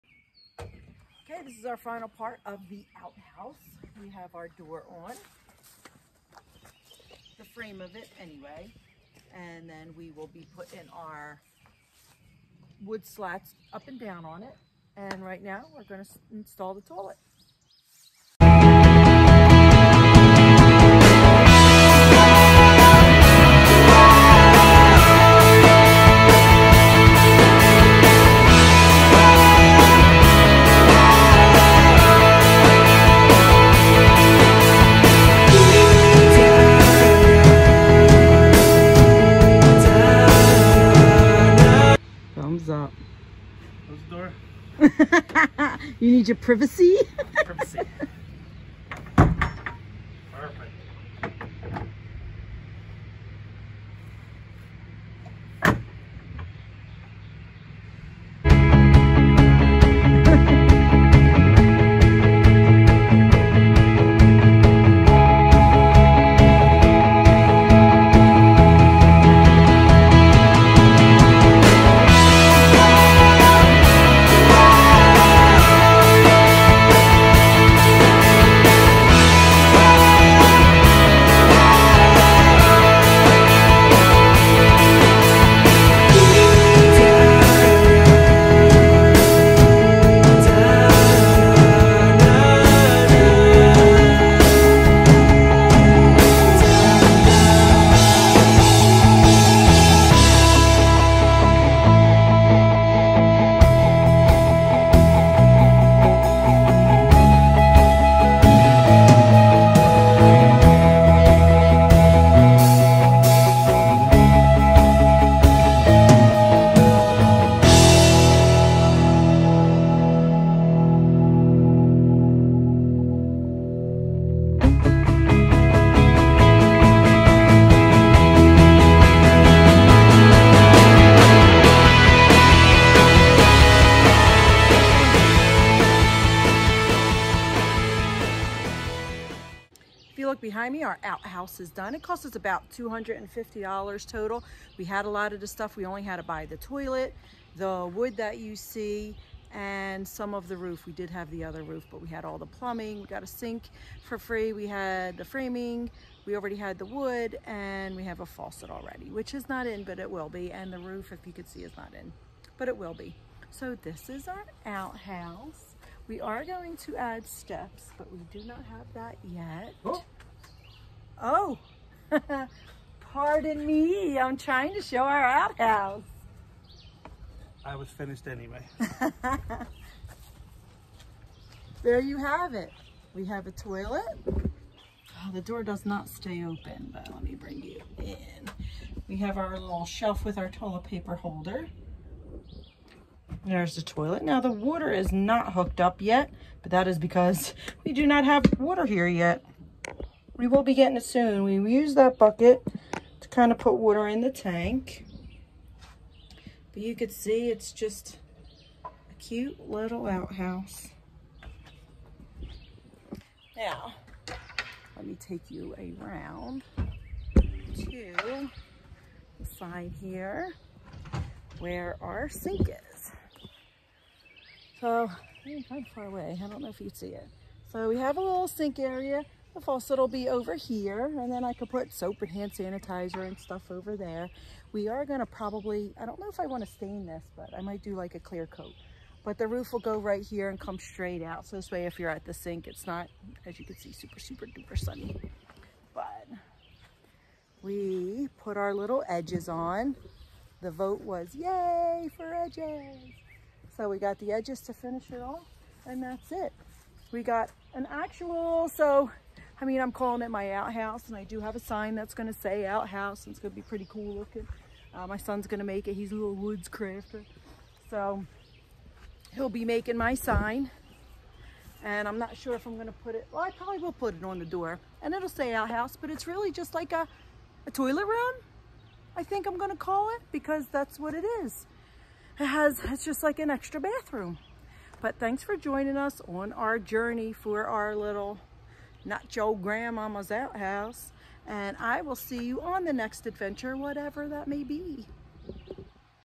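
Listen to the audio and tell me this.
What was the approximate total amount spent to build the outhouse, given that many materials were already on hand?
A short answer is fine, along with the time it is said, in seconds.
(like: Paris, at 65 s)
$250, at 142 s.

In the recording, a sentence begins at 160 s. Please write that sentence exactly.
And the roof, if you could see, is not in, but it will be.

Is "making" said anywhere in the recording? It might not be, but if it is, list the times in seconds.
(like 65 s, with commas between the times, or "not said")
269 s.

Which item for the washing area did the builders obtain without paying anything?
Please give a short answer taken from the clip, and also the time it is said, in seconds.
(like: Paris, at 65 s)
a sink, at 153 s.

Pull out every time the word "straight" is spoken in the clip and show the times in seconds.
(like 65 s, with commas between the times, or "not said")
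240 s.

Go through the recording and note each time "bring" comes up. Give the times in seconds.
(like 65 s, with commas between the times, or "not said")
187 s.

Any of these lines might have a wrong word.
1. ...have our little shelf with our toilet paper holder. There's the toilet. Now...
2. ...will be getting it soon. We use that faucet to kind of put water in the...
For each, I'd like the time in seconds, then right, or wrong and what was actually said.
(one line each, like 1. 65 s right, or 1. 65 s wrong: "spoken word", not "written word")
1. 189 s right
2. 200 s wrong: "bucket", not "faucet".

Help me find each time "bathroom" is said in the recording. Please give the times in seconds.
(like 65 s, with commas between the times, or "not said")
283 s.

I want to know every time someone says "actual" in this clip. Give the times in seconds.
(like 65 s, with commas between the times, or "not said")
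257 s.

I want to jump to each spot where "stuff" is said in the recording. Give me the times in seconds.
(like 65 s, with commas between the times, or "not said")
145 s, 233 s.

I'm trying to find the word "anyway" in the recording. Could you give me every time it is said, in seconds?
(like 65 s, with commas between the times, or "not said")
8 s, 178 s.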